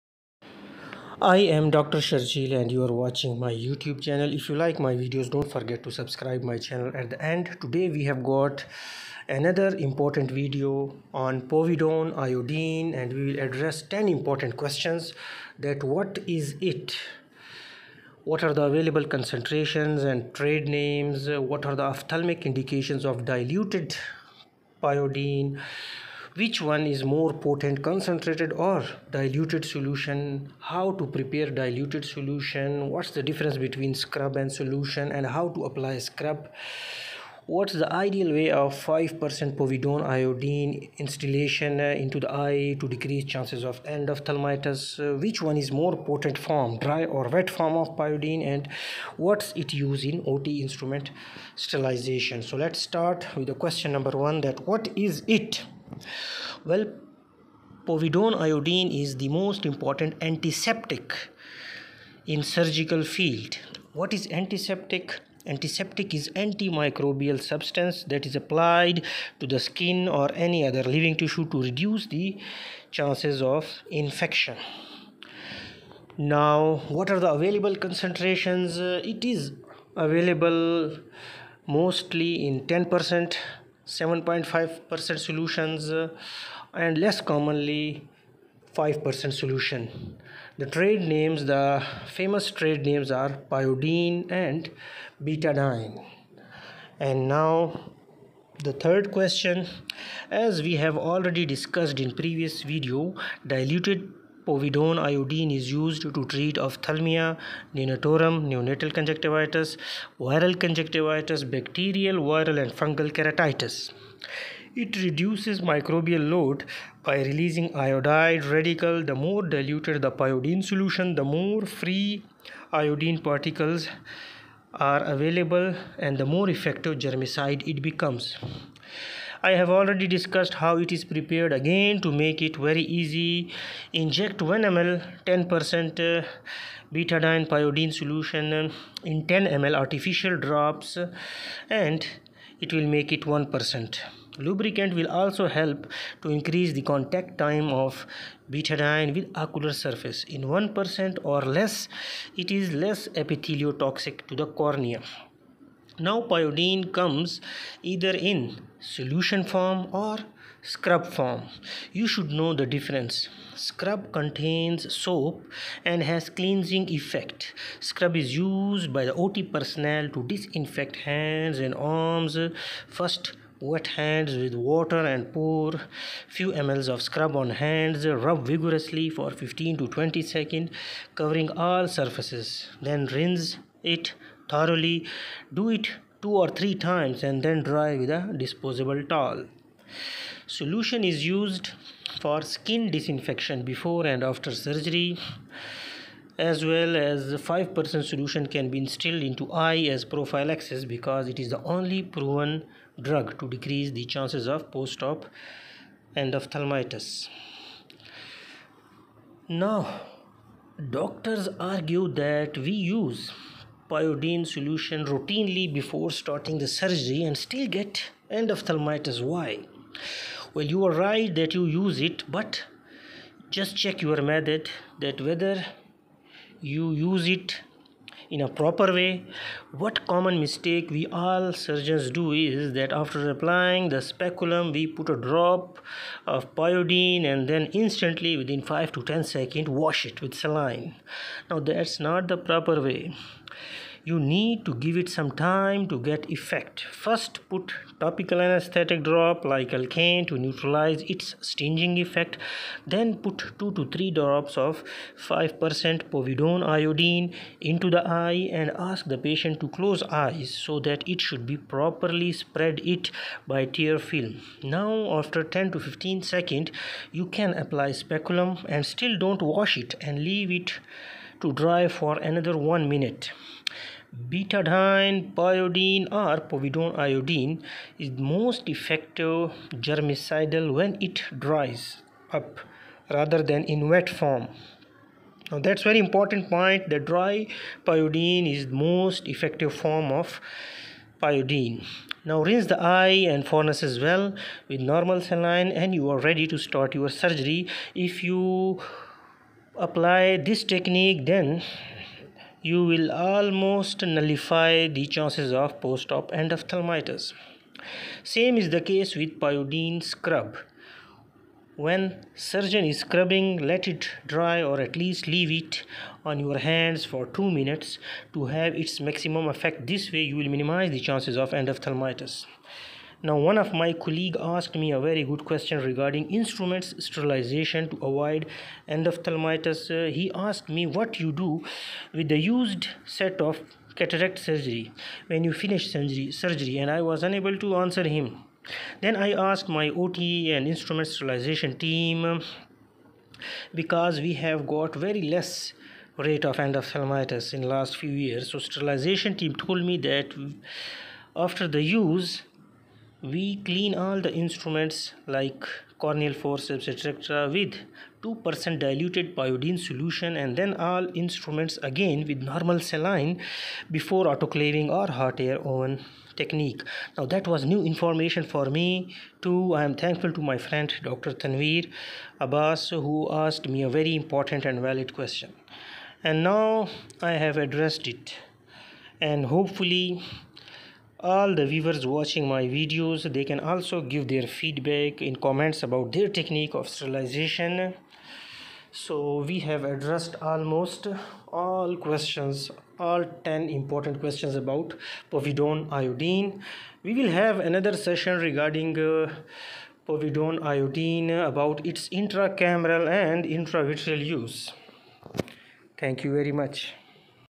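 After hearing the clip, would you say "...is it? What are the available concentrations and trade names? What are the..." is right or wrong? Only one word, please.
right.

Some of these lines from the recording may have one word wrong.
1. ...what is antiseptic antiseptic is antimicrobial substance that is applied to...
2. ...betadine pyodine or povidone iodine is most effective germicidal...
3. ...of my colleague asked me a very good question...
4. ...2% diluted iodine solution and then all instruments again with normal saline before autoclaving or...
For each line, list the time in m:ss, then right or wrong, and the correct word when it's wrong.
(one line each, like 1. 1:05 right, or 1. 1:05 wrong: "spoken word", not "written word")
1. 1:03 right
2. 4:34 right
3. 5:23 right
4. 5:58 right.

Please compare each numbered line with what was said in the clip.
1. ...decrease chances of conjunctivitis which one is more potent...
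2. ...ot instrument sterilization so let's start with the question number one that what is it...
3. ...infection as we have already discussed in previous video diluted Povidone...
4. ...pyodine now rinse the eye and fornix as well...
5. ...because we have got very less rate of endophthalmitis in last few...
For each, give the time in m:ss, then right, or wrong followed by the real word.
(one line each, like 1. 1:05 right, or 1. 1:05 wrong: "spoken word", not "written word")
1. 0:42 wrong: "endophthalmitis", not "conjunctivitis"
2. 0:50 right
3. 1:39 wrong: "question", not "infection"
4. 4:51 right
5. 5:43 right.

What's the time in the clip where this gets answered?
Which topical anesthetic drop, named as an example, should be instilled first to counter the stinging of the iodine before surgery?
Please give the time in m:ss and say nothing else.
4:09.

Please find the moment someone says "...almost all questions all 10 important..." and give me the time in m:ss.
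6:30.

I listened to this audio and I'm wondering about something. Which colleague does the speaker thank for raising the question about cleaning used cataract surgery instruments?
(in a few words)
Dr Tanveer Abbas.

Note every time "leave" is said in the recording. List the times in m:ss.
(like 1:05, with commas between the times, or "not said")
4:30, 5:15.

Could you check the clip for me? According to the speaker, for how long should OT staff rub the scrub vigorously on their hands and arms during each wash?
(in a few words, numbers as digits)
15 to 20 seconds.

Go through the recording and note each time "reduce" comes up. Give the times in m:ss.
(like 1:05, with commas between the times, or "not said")
1:11, 1:55.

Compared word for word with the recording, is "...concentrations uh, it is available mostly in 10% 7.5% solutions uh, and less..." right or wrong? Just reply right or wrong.
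right.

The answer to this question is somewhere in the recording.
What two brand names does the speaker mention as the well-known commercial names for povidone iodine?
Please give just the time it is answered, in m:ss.
1:33.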